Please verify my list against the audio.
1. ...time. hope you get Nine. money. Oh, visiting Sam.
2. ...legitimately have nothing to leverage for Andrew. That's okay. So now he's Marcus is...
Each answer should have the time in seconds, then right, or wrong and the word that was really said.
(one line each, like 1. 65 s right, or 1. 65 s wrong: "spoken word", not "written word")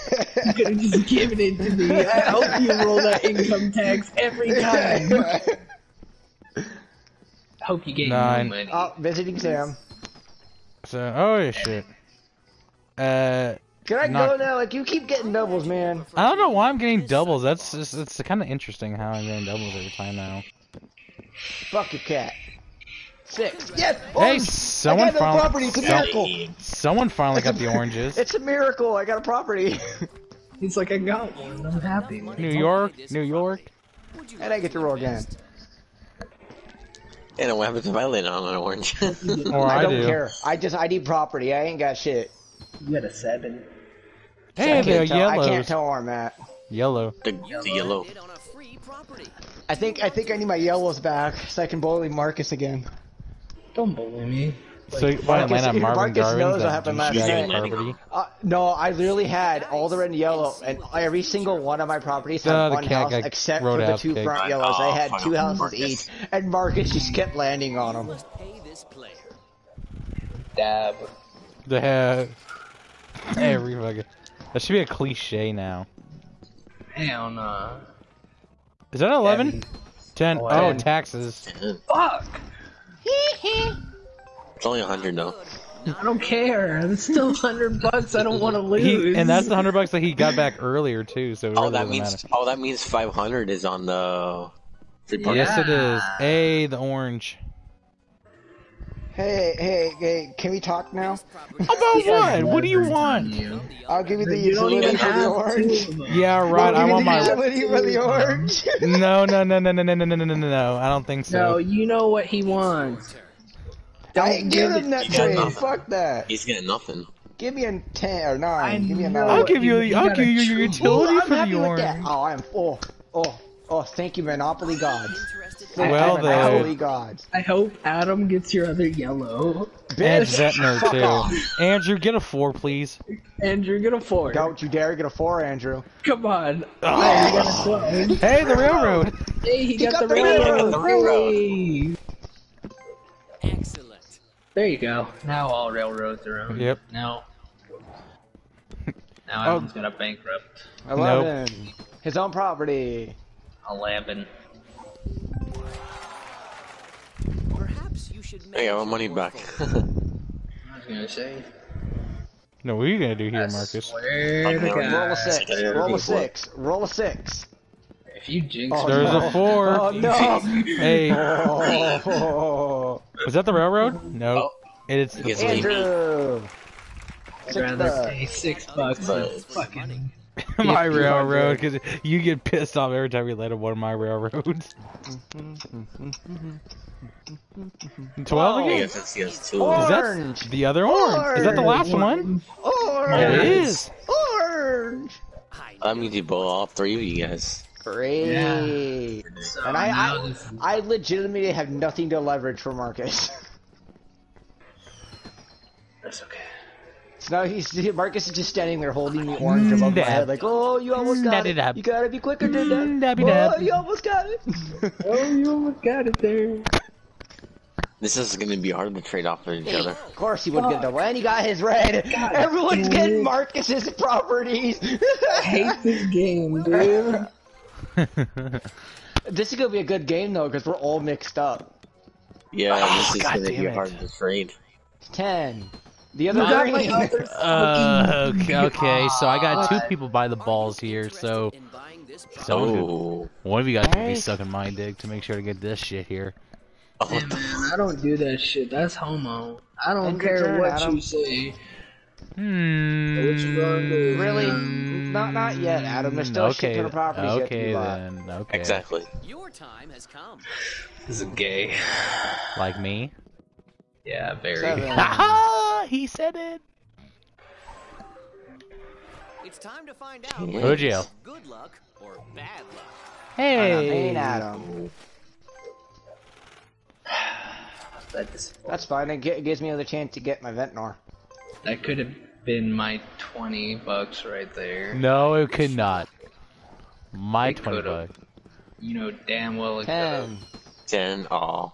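1. 4 s right
2. 200 s wrong: "Marcus", not "Andrew".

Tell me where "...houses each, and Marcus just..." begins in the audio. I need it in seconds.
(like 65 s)
65 s.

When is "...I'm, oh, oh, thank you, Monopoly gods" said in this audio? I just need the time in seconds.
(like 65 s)
122 s.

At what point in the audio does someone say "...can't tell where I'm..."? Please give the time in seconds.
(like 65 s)
45 s.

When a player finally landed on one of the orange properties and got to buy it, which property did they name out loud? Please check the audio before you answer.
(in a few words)
New York.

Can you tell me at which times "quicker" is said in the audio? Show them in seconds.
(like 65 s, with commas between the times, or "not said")
212 s.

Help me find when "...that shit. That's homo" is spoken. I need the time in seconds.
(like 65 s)
248 s.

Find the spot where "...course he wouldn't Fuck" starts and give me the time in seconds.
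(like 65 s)
220 s.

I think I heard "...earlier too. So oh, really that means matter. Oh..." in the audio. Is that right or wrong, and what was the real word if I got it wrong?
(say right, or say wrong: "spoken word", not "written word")
right.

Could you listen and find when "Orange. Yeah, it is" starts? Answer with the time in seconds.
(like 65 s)
192 s.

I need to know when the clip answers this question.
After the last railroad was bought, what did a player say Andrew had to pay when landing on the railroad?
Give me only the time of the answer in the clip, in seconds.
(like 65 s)
178 s.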